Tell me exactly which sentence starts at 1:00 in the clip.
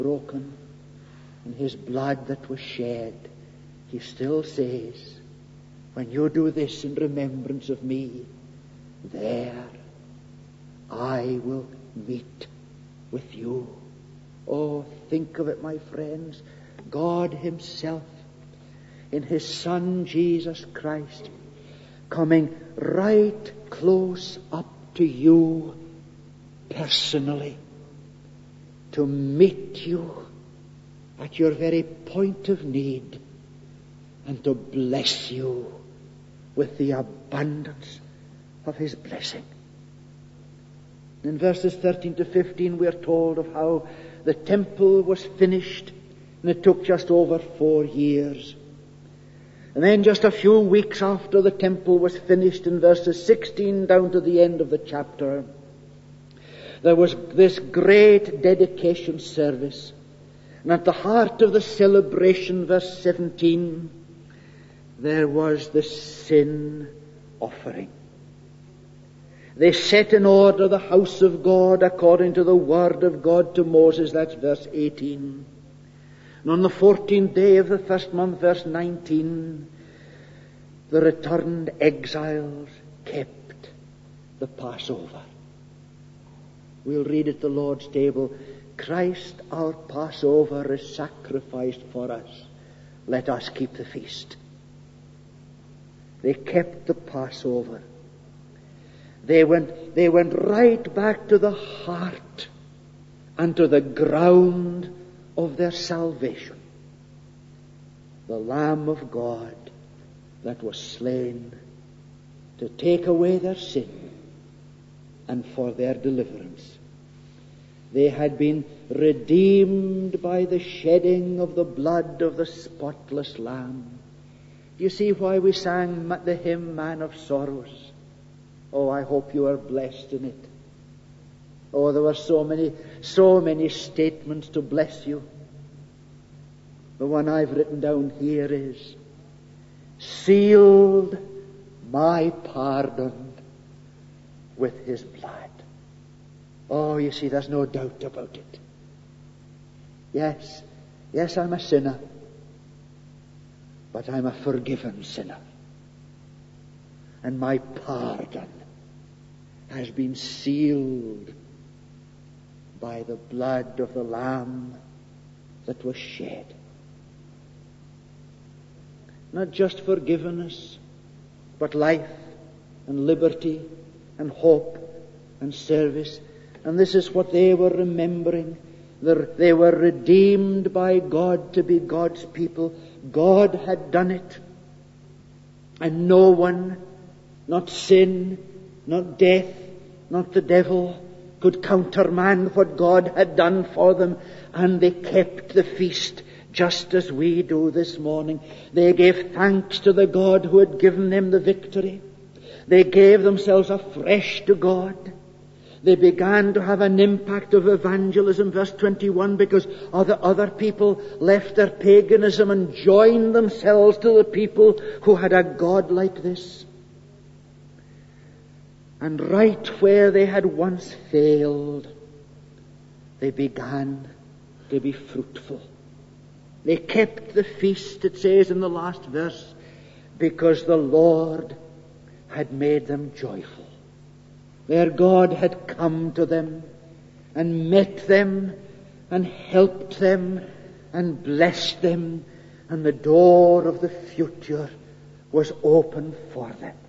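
And at the heart of the celebration, verse 17, there was the sin offering.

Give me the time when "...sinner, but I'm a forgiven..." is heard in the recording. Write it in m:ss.
2:31.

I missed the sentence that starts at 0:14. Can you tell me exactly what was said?
Oh, think of it, my friends.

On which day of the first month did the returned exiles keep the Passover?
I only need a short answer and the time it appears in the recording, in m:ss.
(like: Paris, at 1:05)
14th, at 1:16.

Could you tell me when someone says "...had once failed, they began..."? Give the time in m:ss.
3:40.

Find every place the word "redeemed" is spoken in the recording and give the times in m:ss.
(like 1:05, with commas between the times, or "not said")
1:58, 2:59.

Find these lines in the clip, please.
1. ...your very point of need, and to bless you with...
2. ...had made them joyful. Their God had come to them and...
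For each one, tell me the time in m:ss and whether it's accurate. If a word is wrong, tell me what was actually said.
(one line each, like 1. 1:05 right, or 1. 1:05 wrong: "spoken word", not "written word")
1. 0:31 right
2. 3:52 right.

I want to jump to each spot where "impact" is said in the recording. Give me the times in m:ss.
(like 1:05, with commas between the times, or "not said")
3:26.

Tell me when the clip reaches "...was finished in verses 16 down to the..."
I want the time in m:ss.
0:51.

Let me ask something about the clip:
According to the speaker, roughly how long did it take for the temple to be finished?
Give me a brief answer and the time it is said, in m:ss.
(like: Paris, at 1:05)
just over 4 years, at 0:46.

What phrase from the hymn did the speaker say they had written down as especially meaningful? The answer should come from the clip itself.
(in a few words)
sealed my pardon with his blood.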